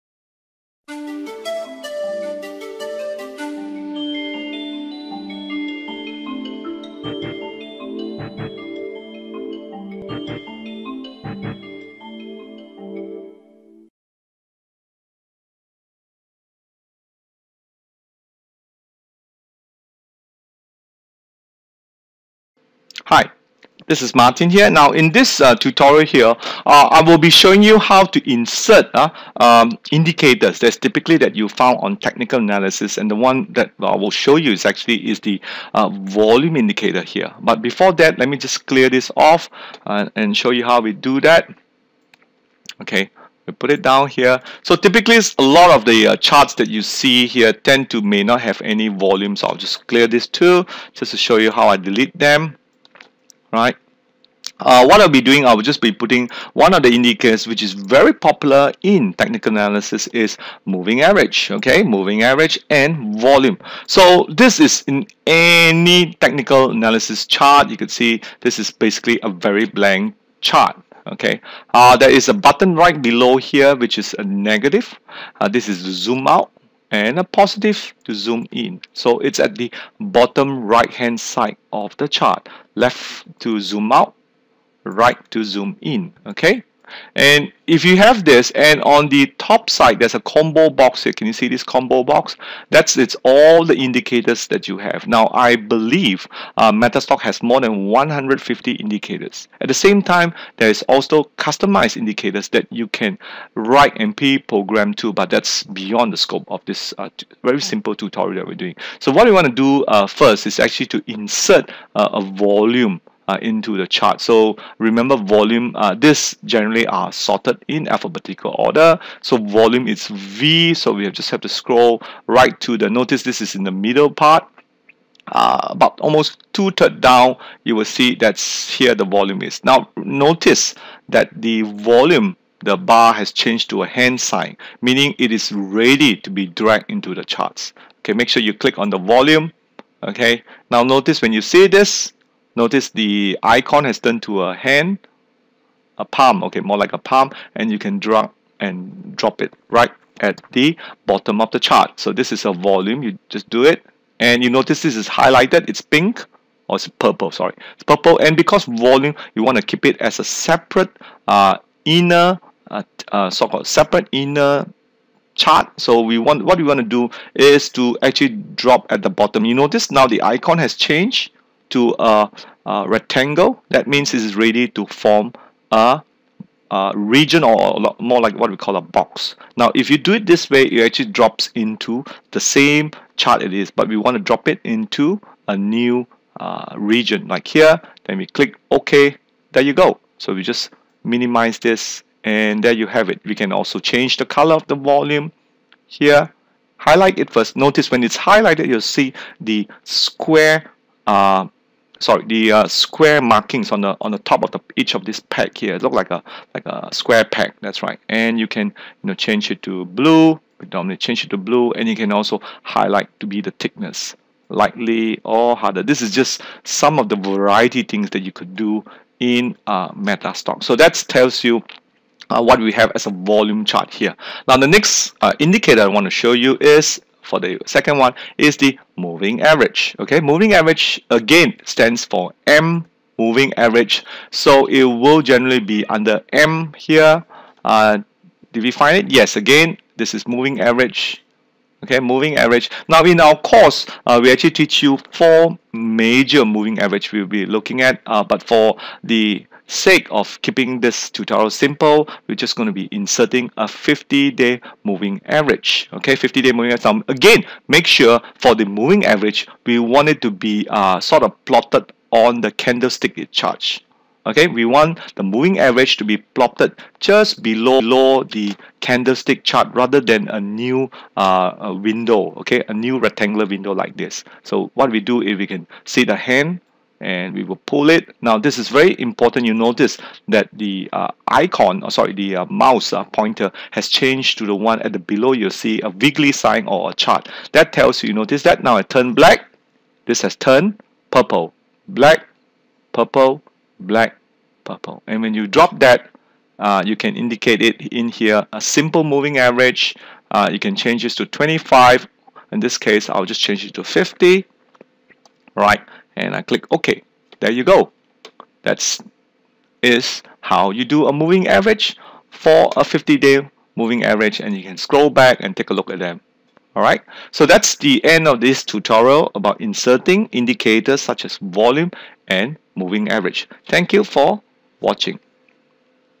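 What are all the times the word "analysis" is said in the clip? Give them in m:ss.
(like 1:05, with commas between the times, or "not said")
0:32, 0:59, 1:06.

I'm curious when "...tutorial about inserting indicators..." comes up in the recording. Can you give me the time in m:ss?
5:18.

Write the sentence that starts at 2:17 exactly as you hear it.
Okay, make sure you click on the volume.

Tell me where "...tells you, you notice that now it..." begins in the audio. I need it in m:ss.
4:47.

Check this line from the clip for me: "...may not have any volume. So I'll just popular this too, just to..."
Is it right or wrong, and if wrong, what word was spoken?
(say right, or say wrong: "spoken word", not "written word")
wrong: "clear", not "popular".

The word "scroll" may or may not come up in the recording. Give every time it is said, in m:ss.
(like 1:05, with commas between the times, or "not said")
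2:01, 5:14.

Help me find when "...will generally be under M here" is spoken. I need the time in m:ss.
3:54.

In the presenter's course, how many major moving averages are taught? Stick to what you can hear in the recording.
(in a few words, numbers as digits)
4.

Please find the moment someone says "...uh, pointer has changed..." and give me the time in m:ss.
4:42.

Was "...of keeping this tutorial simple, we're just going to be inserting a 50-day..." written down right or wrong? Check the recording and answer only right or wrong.
right.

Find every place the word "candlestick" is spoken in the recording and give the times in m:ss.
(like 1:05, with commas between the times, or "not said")
4:22, 4:28.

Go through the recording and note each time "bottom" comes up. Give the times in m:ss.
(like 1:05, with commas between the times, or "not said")
1:19, 2:31, 2:49.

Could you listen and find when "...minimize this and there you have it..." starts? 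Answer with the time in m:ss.
3:11.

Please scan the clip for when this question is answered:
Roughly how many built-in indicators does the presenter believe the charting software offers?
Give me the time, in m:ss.
1:37.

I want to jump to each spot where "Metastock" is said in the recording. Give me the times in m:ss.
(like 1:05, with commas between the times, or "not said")
1:36, 3:39.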